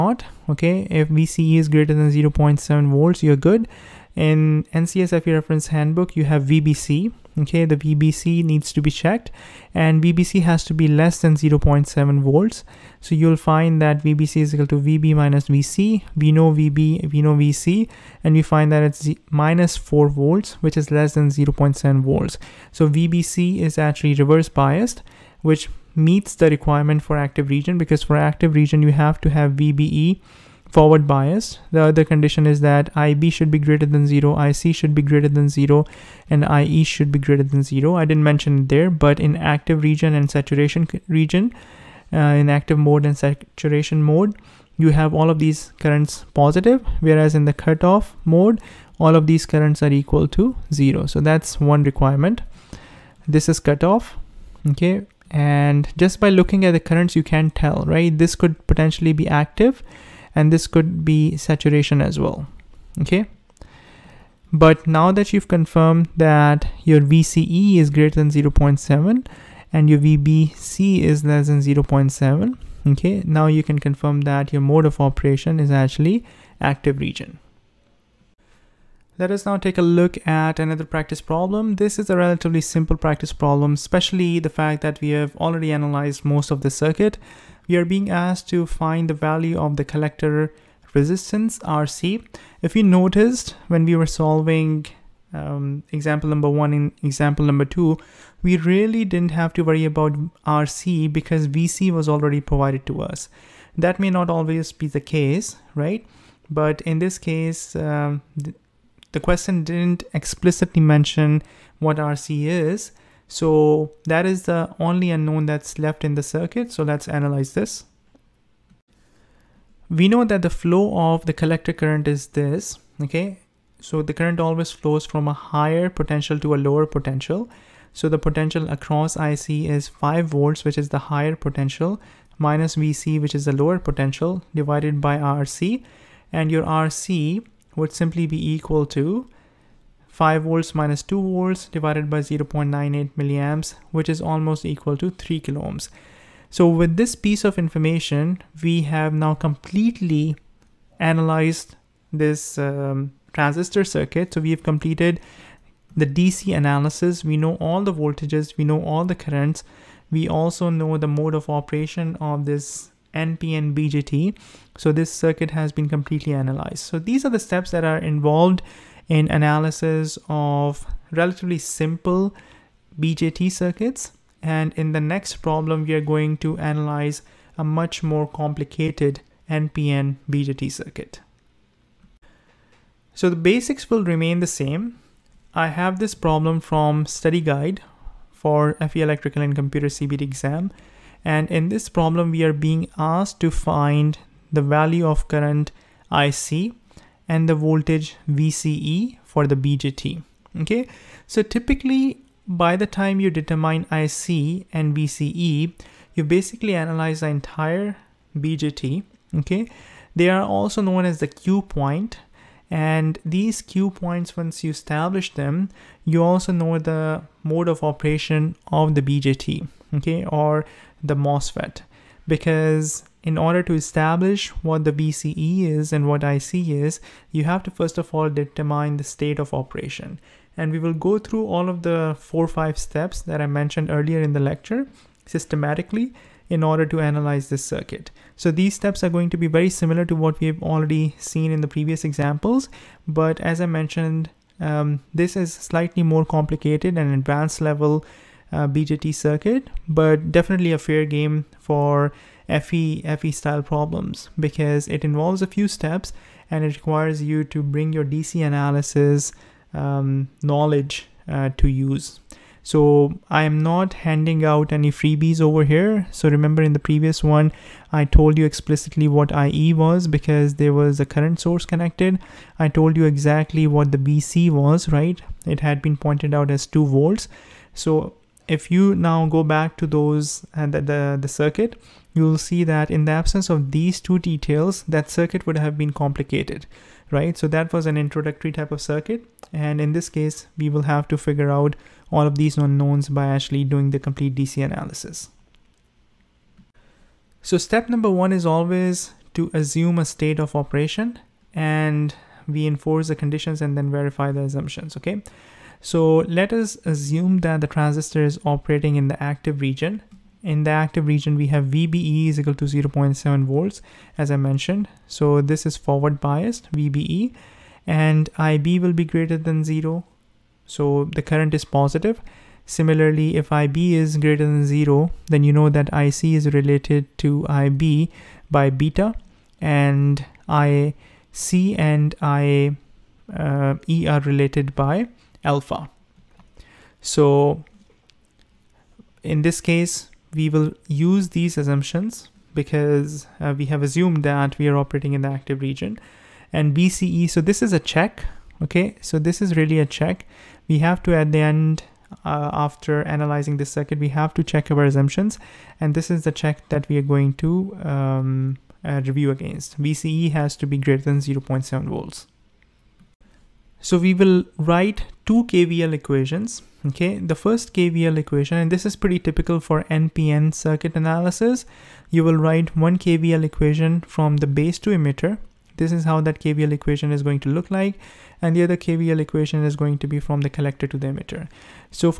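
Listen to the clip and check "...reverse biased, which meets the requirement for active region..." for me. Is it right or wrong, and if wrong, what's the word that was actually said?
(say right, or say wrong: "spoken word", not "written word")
right.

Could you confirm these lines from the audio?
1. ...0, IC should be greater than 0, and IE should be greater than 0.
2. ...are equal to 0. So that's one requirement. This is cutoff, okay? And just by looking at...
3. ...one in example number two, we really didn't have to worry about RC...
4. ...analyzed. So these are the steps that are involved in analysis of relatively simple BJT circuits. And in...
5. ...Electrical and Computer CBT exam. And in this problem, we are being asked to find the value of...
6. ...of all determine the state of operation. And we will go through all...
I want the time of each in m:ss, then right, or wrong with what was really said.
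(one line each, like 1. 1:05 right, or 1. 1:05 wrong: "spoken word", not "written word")
1. 0:34 right
2. 0:49 right
3. 1:36 right
4. 2:46 right
5. 3:09 right
6. 3:47 right.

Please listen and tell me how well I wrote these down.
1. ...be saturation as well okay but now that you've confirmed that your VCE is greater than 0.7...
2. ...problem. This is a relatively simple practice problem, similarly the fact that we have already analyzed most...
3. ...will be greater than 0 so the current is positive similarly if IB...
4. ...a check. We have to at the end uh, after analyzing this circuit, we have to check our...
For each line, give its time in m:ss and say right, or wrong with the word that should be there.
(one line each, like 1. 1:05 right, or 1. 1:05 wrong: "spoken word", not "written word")
1. 1:01 right
2. 1:21 wrong: "especially", not "similarly"
3. 5:18 right
4. 5:49 right.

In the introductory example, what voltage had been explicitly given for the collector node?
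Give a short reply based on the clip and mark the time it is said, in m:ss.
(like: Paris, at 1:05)
2 volts, at 4:36.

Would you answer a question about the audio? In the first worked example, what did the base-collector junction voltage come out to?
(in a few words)
-4 volts.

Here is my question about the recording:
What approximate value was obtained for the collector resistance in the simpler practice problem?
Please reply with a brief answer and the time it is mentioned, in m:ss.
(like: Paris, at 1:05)
3 kilo ohms, at 2:25.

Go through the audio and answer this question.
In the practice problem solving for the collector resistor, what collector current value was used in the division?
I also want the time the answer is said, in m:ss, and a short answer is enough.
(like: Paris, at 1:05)
0.98 milliamps, at 2:22.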